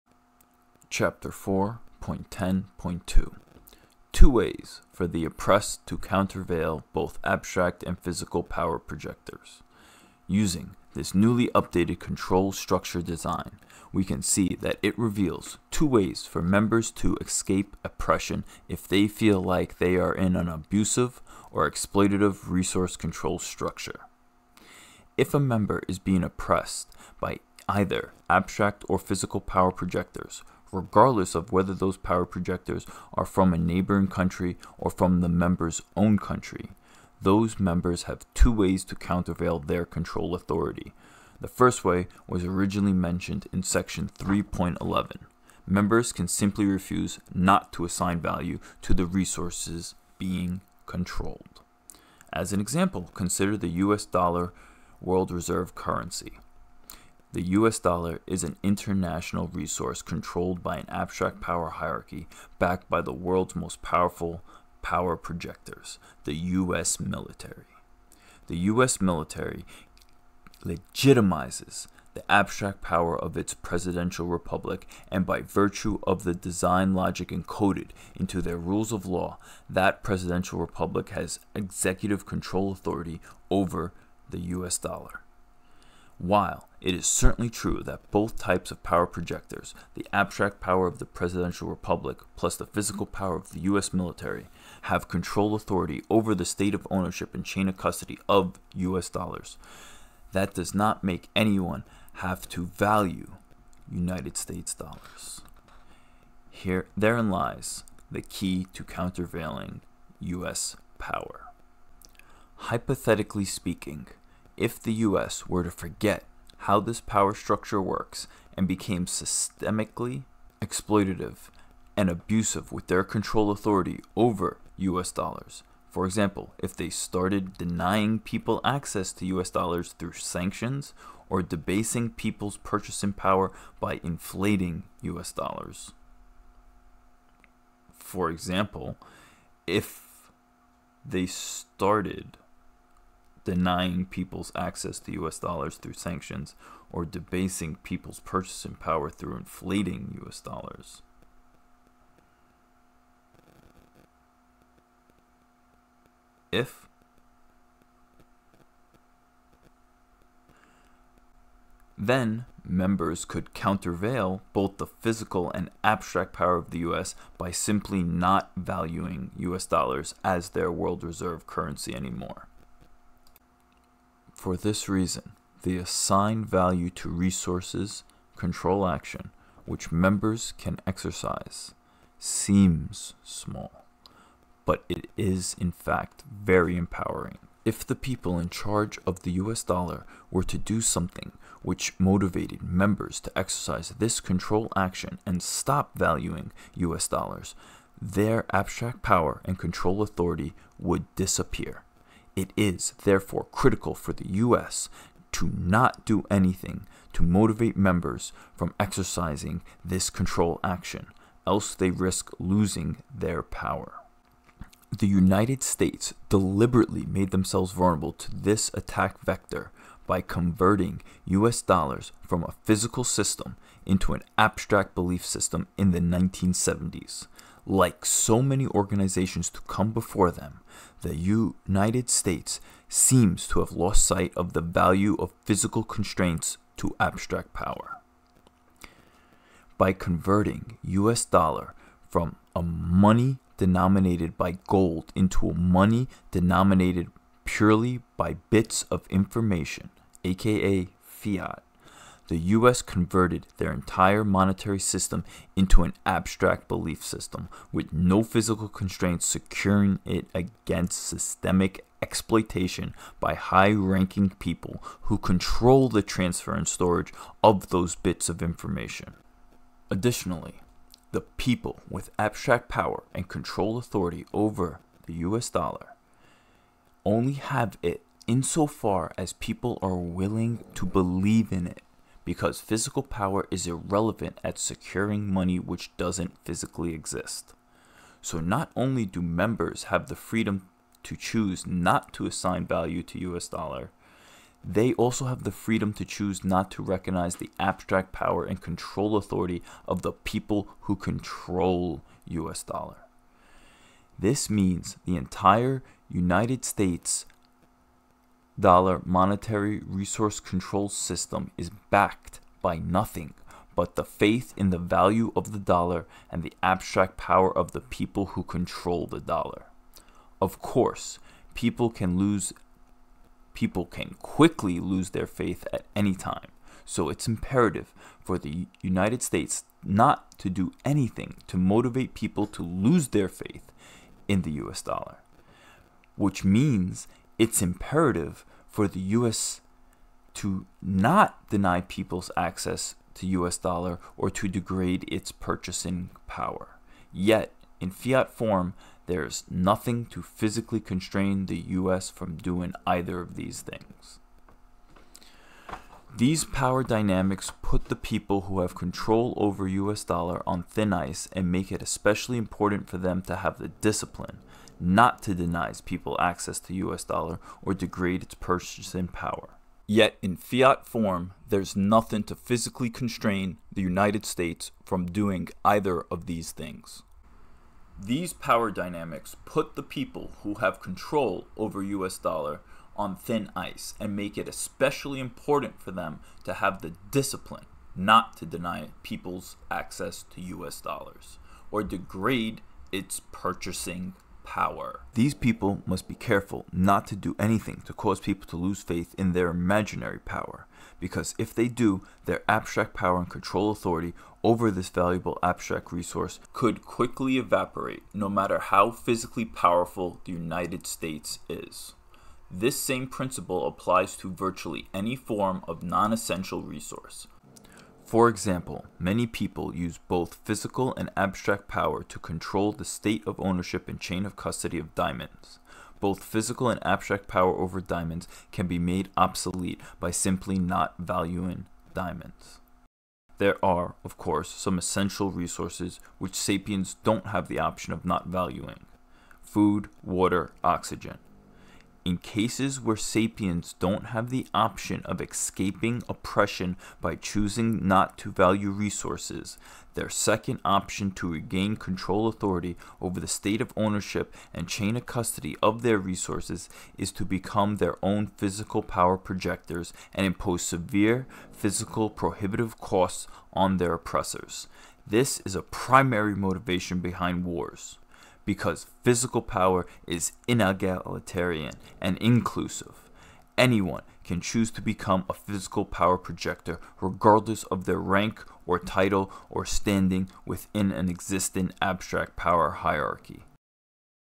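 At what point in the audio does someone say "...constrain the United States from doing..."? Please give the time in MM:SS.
06:12.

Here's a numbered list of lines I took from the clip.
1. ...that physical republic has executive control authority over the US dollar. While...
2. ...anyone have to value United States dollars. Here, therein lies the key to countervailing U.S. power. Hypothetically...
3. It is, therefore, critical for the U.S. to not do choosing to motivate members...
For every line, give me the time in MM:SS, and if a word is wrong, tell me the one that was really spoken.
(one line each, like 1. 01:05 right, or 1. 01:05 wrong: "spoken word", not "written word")
1. 01:19 wrong: "presidential", not "physical"
2. 01:41 right
3. 03:22 wrong: "anything", not "choosing".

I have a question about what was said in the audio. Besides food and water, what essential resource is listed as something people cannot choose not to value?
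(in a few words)
oxygen.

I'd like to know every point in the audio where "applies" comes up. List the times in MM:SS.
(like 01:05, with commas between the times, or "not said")
06:53.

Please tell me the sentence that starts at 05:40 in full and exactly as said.
to not deny people's access to U.S.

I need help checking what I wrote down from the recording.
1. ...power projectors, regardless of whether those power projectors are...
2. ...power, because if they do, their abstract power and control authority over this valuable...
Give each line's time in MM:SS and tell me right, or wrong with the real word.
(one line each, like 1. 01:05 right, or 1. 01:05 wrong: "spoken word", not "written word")
1. 00:29 right
2. 06:40 right.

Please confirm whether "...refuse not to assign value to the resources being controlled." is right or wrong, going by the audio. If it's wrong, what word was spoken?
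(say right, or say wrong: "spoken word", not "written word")
right.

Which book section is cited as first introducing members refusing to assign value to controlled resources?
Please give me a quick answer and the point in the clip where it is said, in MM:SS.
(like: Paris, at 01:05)
3.11, at 00:43.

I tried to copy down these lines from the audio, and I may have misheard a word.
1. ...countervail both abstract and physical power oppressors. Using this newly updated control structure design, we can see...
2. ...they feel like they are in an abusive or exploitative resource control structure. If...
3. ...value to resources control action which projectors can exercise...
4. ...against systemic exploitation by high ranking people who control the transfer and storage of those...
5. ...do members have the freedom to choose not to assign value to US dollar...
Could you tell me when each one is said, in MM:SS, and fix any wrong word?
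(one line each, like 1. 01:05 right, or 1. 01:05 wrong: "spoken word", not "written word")
1. 00:05 wrong: "projectors", not "oppressors"
2. 00:18 right
3. 02:56 wrong: "members", not "projectors"
4. 04:20 right
5. 04:49 right.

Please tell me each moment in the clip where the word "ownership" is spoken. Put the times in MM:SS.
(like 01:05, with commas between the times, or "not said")
01:36, 07:03, 07:33.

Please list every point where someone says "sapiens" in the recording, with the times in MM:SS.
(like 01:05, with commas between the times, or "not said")
07:16, 07:22.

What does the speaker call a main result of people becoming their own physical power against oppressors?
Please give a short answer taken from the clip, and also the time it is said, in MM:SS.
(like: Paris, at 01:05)
wars, at 07:47.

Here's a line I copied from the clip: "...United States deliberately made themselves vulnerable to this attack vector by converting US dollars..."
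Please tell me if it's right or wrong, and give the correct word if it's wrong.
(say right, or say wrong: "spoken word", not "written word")
right.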